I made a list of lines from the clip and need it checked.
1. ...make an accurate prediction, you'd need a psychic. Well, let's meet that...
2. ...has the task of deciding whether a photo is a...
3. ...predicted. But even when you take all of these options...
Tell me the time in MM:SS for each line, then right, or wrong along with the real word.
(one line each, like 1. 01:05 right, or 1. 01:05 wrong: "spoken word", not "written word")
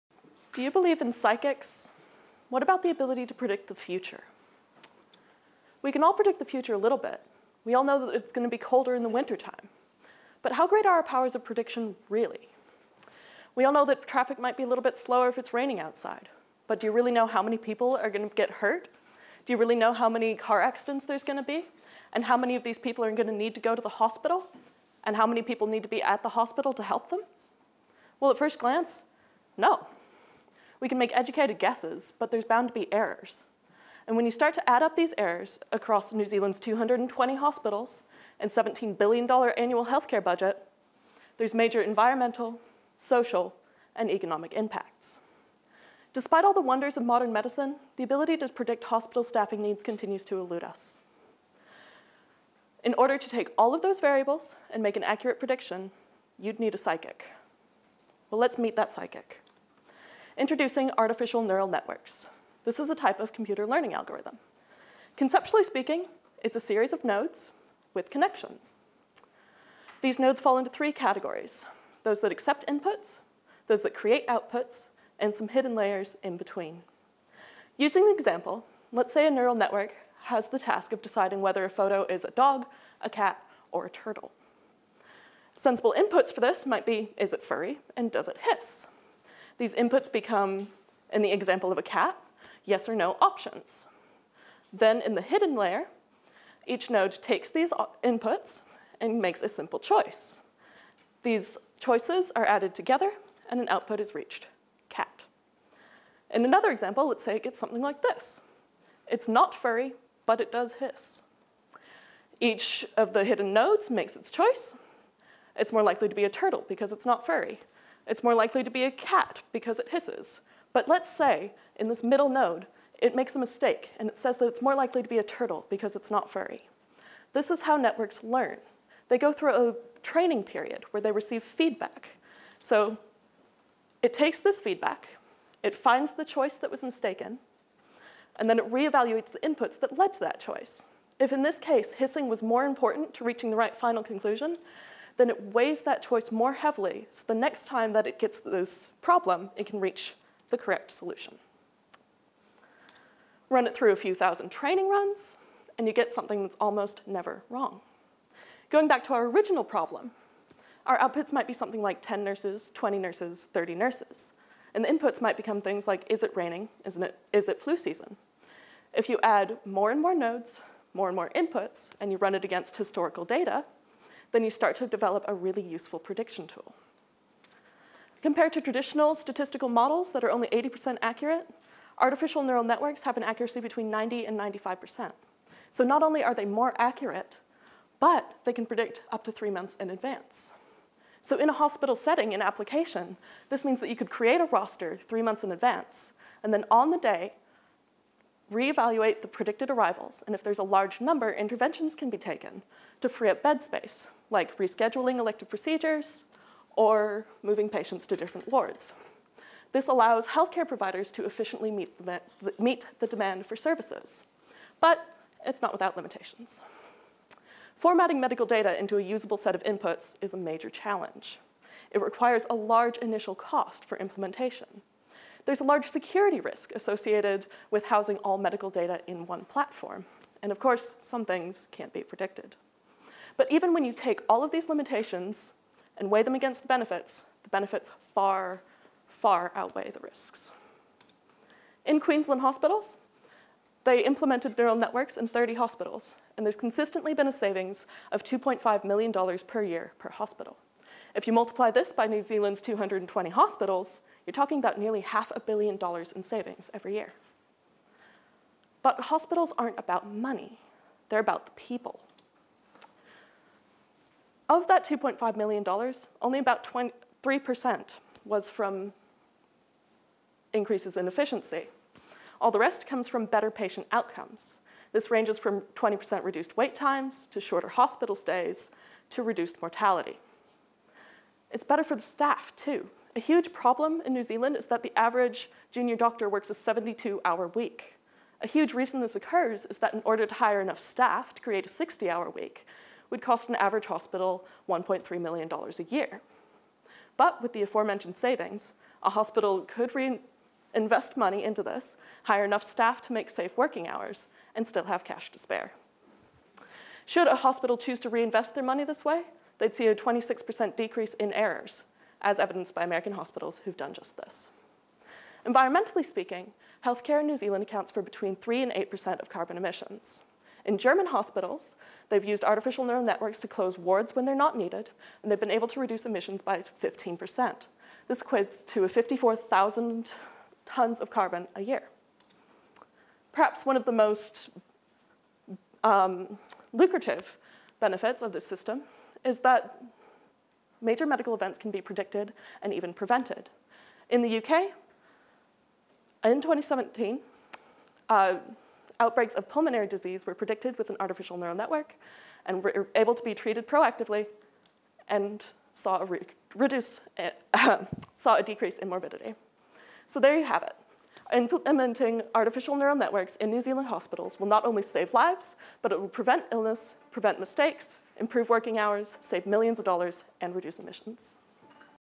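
1. 00:54 right
2. 01:20 right
3. 03:52 wrong: "limitations", not "options".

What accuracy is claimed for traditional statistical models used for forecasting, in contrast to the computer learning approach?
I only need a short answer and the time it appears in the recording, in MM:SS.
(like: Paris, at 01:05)
80%, at 03:00.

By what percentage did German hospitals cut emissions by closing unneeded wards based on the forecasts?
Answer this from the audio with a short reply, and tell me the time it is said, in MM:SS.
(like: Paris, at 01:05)
15%, at 05:26.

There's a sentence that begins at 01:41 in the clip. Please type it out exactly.
These choices are added together and an output is reached, cat.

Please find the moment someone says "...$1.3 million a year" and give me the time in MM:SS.
04:54.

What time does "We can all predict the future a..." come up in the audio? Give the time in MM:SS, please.
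00:05.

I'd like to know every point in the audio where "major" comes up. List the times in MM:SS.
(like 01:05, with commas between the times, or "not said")
00:41, 03:40, 05:40.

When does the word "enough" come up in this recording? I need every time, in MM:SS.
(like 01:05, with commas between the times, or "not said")
04:50, 05:02.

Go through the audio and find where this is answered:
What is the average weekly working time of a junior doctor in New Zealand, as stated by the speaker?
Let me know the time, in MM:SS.
04:46.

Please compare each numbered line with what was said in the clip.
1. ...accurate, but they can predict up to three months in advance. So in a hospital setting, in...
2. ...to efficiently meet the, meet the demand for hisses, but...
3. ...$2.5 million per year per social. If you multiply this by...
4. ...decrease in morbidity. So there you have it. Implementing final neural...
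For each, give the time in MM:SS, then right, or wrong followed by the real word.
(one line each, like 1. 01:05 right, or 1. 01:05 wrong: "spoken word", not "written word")
1. 03:06 right
2. 03:31 wrong: "services", not "hisses"
3. 04:08 wrong: "hospital", not "social"
4. 05:58 wrong: "artificial", not "final".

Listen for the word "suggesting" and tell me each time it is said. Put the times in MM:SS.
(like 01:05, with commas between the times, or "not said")
not said.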